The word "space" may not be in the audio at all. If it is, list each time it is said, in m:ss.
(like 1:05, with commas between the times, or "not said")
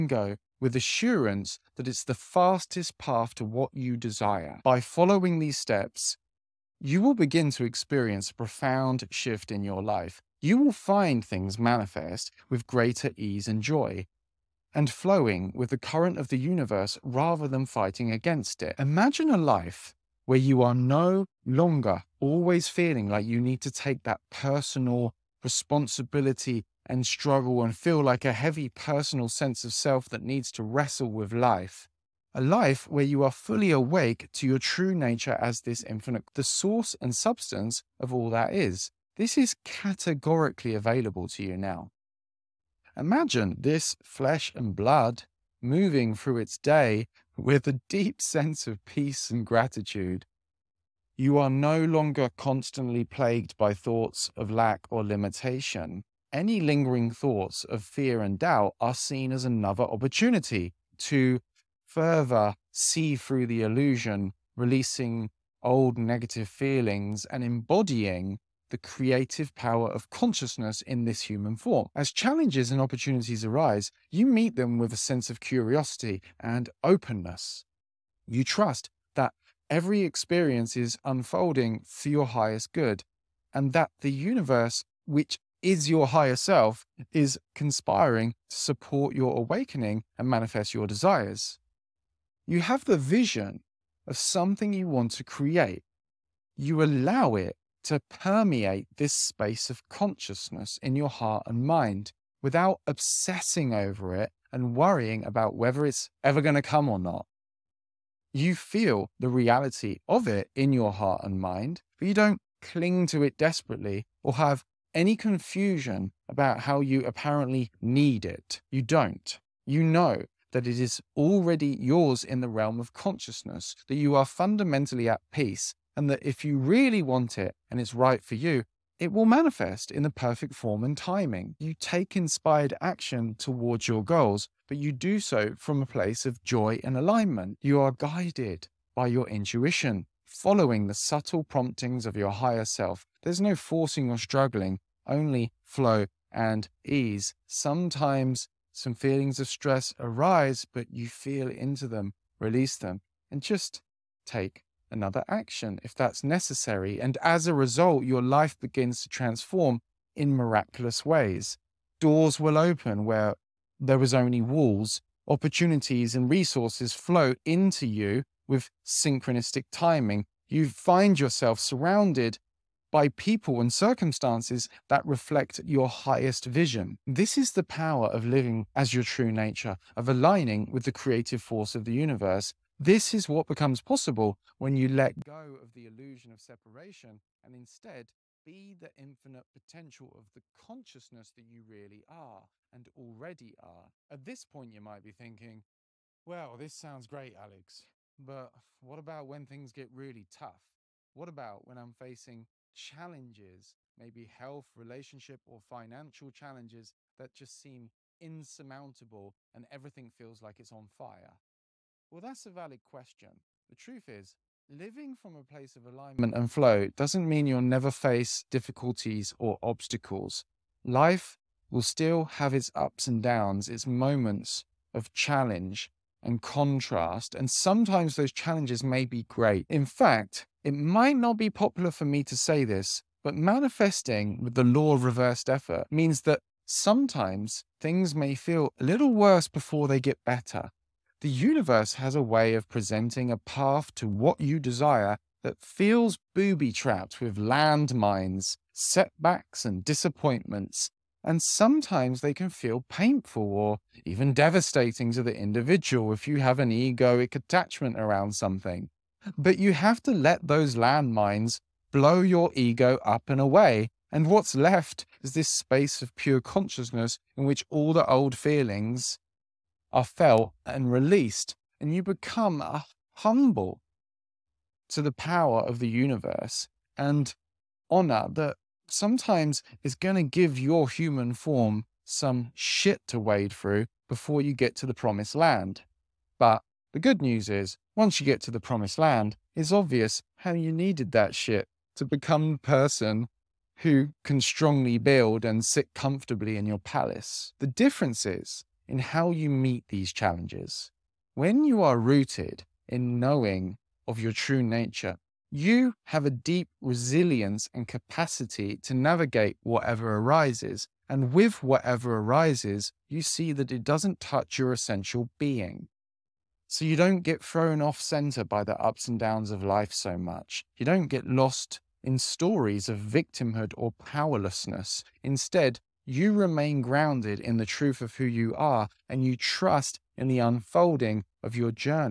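1:39, 4:25.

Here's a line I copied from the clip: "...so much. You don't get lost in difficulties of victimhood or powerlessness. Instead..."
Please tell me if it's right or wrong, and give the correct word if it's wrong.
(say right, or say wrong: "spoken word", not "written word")
wrong: "stories", not "difficulties".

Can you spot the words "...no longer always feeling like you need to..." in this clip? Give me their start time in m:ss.
0:20.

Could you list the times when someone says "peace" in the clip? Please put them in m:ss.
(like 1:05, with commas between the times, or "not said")
0:48, 2:05.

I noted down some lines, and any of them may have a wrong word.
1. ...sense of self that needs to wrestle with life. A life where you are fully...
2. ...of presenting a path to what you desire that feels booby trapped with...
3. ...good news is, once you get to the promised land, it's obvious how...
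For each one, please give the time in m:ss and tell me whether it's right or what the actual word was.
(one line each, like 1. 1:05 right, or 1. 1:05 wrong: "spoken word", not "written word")
1. 0:29 right
2. 4:02 right
3. 4:46 right.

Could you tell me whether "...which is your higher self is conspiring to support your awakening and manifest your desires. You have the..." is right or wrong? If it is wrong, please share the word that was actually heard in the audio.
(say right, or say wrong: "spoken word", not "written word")
right.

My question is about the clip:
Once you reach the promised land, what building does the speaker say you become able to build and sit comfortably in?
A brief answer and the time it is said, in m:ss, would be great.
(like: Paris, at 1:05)
palace, at 4:56.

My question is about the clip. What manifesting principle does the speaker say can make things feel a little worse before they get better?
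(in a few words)
law of reversed effort.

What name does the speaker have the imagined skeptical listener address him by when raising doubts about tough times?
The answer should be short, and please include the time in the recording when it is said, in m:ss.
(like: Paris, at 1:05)
Alex, at 3:17.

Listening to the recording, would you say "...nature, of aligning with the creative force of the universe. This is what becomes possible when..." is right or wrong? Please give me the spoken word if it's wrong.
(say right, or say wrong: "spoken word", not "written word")
right.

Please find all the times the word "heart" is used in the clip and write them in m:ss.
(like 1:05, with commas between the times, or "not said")
1:41, 1:50.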